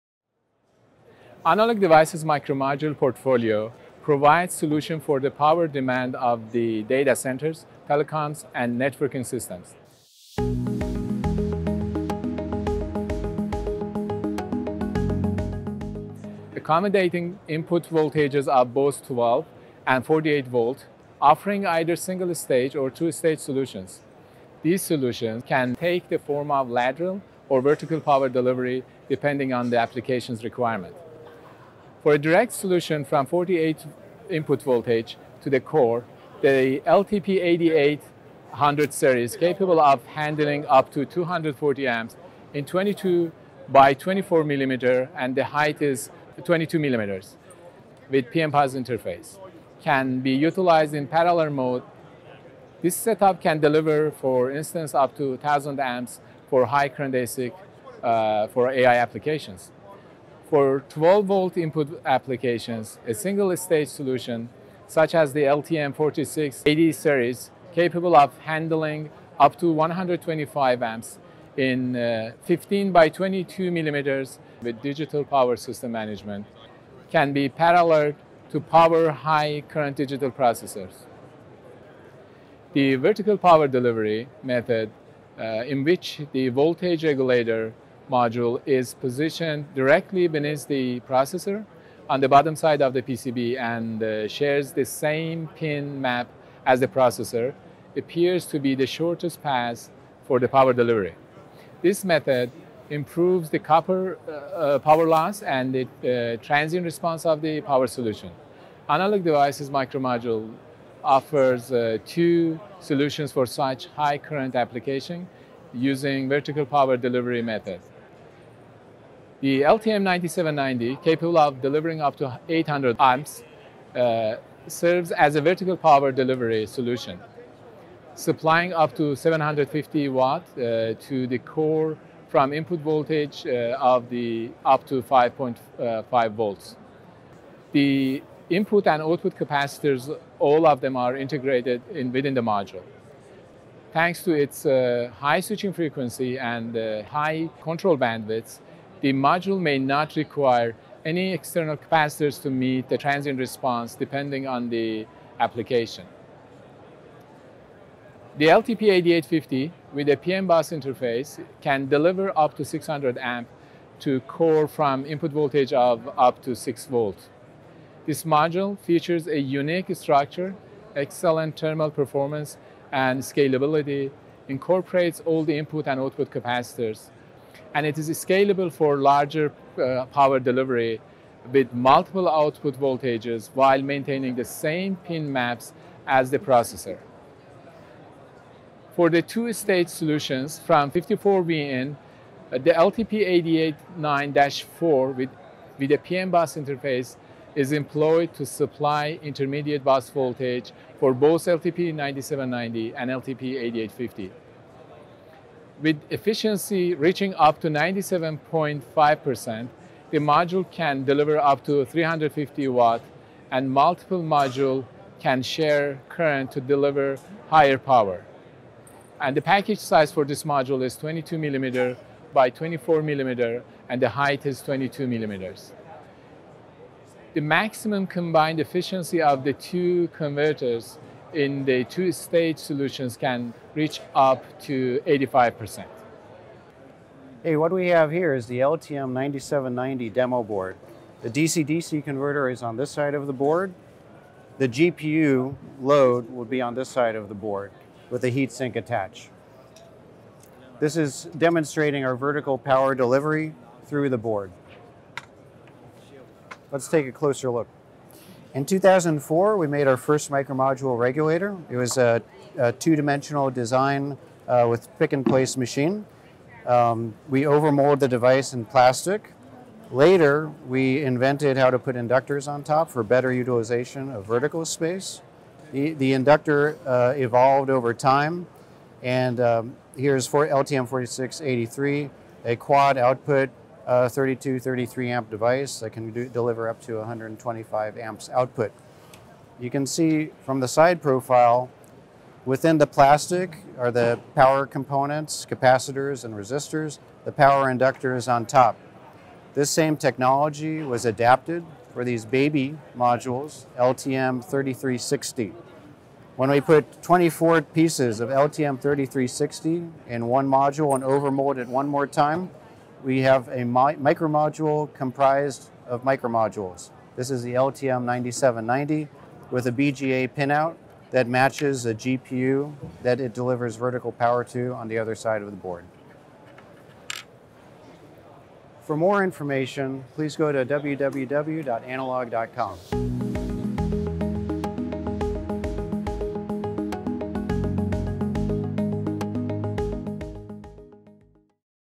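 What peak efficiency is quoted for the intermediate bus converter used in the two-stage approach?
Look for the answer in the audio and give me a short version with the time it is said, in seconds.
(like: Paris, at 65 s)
97.5%, at 207 s.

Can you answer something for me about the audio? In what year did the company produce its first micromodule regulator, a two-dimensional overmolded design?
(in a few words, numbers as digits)
2004.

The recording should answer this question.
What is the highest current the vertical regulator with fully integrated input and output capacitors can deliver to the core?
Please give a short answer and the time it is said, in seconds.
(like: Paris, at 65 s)
800 amps, at 122 s.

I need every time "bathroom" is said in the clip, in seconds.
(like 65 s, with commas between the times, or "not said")
not said.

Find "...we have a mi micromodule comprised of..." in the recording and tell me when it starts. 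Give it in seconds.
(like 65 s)
313 s.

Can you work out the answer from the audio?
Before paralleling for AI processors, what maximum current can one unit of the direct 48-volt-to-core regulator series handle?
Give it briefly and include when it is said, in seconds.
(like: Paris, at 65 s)
240 amps, at 41 s.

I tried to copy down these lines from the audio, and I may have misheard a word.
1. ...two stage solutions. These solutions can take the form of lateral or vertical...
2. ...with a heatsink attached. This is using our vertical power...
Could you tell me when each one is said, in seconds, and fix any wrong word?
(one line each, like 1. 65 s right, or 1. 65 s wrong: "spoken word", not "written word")
1. 22 s right
2. 248 s wrong: "demonstrating", not "using".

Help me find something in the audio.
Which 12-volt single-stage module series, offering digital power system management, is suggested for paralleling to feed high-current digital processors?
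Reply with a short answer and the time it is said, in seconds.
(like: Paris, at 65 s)
LTM4680, at 65 s.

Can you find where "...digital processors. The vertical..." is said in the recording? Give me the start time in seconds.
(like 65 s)
79 s.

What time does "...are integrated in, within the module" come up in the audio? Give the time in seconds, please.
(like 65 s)
140 s.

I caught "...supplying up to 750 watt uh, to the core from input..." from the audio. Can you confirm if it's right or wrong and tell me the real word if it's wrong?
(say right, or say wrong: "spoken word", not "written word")
right.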